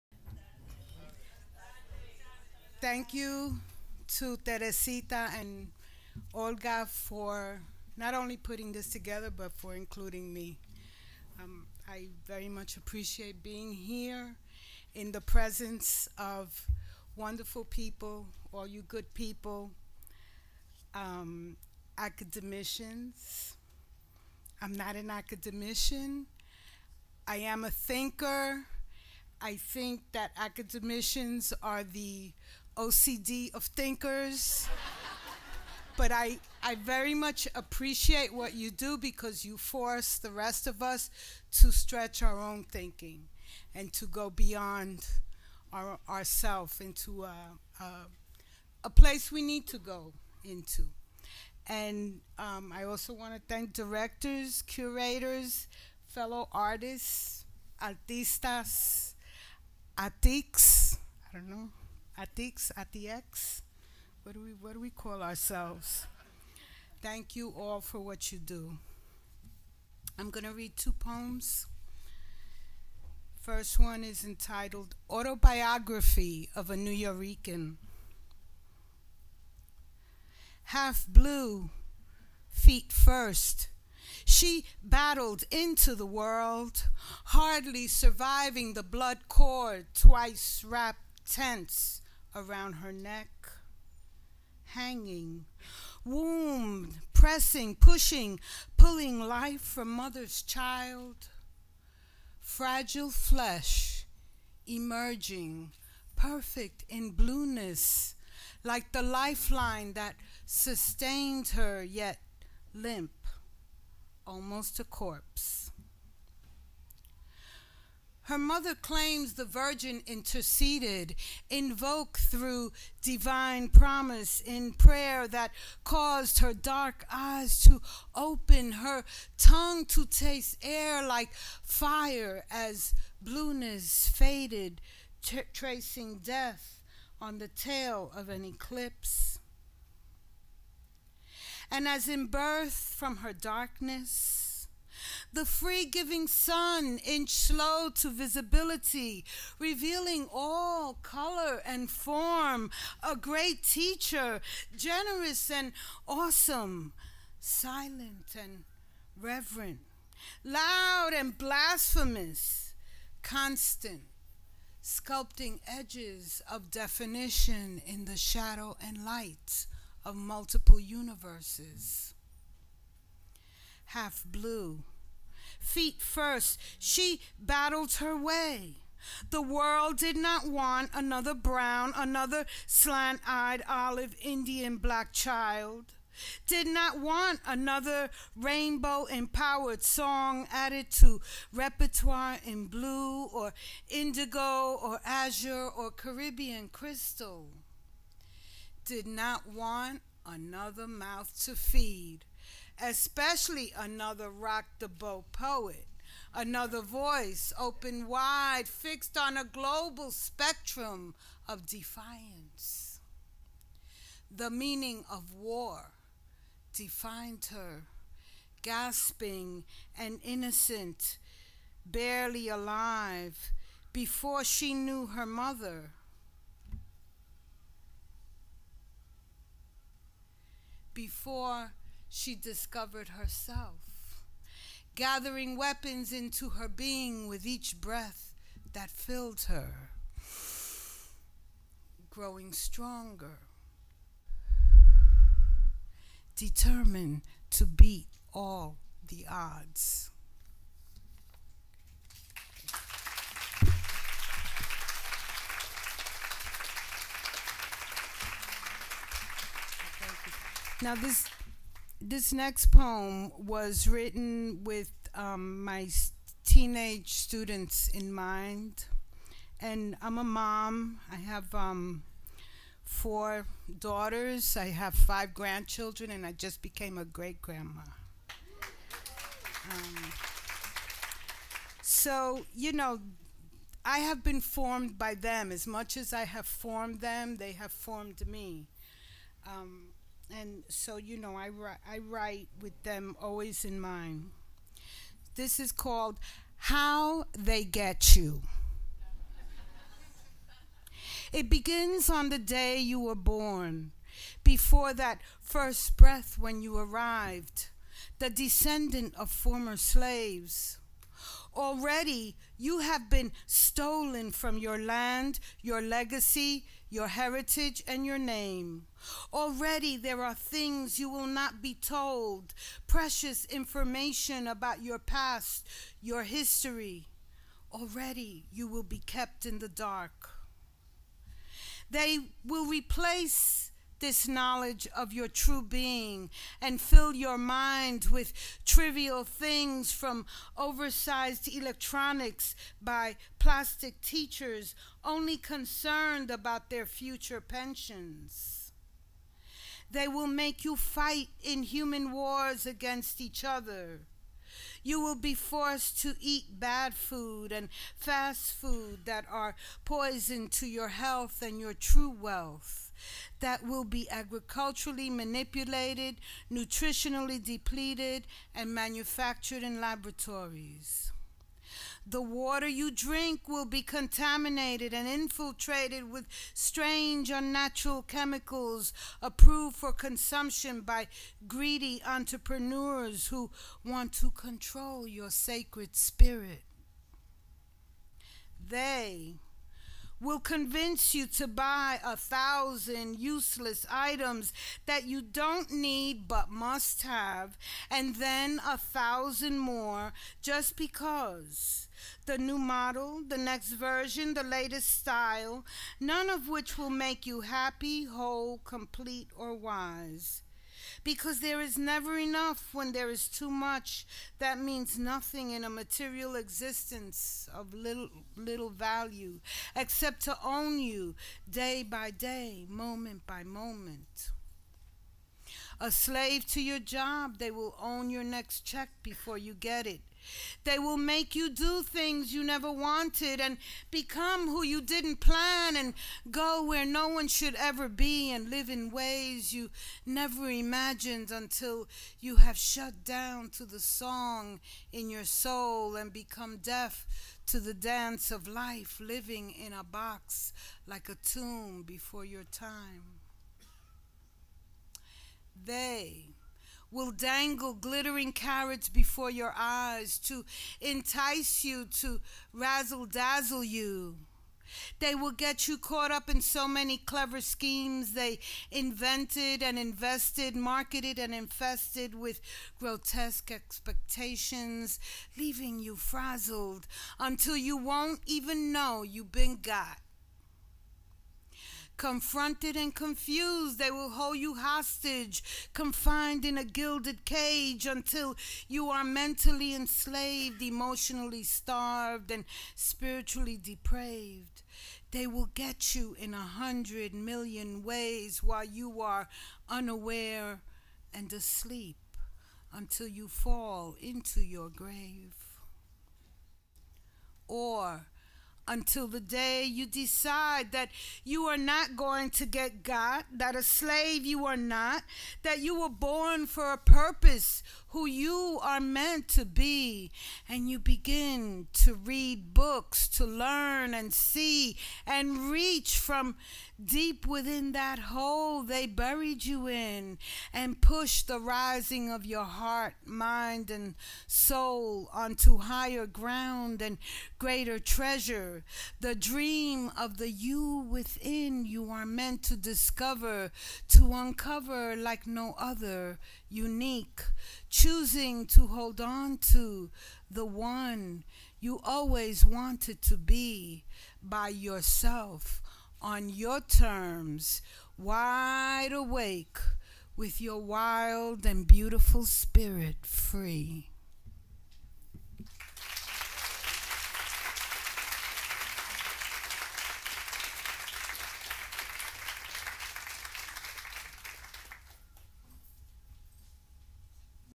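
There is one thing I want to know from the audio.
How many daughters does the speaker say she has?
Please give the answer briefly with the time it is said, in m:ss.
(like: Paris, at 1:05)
Four, at 4:32.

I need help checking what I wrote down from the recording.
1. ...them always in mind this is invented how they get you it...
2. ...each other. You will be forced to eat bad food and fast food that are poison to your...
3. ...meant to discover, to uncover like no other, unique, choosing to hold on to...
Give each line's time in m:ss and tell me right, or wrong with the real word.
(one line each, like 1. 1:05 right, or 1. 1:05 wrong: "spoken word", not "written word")
1. 4:52 wrong: "called", not "invented"
2. 5:53 right
3. 9:02 right.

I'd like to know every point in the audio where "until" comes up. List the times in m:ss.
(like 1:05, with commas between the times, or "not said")
7:21, 7:57, 8:07, 8:22, 8:28.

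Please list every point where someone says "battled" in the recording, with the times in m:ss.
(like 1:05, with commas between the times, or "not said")
1:24, 2:57.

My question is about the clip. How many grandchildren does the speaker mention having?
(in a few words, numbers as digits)
Five.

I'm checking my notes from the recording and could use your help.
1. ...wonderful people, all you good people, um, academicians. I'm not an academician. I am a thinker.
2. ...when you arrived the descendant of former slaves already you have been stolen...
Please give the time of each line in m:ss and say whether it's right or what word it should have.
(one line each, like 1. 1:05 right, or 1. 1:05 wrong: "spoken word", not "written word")
1. 0:17 right
2. 5:06 right.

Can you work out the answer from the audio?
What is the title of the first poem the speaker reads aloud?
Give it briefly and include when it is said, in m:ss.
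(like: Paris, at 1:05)
Autobiography of a Nuyorican, at 1:15.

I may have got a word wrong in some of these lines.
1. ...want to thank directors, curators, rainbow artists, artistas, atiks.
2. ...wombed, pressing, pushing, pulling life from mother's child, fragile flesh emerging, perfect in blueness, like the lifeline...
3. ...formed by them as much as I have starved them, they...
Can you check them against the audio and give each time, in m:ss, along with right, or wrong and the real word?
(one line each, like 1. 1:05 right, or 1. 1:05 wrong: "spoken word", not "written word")
1. 0:53 wrong: "fellow", not "rainbow"
2. 1:36 right
3. 4:44 wrong: "formed", not "starved".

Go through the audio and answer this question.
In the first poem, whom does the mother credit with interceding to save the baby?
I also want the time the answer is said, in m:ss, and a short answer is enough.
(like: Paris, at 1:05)
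The Virgin, at 1:59.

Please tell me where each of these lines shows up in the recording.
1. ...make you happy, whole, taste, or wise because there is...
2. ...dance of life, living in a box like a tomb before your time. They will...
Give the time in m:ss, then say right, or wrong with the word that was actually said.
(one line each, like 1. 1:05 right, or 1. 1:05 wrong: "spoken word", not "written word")
1. 6:46 wrong: "complete", not "taste"
2. 7:27 right.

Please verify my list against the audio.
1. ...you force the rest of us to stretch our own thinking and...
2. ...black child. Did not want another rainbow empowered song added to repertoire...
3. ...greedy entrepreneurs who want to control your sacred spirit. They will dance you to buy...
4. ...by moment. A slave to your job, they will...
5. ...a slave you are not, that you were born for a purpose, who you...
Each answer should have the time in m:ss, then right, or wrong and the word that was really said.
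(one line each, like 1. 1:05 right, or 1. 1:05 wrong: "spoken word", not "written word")
1. 0:39 right
2. 3:04 right
3. 6:21 wrong: "convince", not "dance"
4. 7:03 right
5. 8:33 right.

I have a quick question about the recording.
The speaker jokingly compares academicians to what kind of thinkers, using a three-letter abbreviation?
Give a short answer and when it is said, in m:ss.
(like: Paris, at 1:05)
OCD, at 0:32.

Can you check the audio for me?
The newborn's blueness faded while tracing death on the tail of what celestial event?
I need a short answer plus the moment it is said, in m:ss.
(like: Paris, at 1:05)
An eclipse, at 2:18.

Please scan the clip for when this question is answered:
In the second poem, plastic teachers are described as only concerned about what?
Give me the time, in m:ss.
5:46.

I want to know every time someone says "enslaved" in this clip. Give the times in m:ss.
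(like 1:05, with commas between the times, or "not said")
8:09.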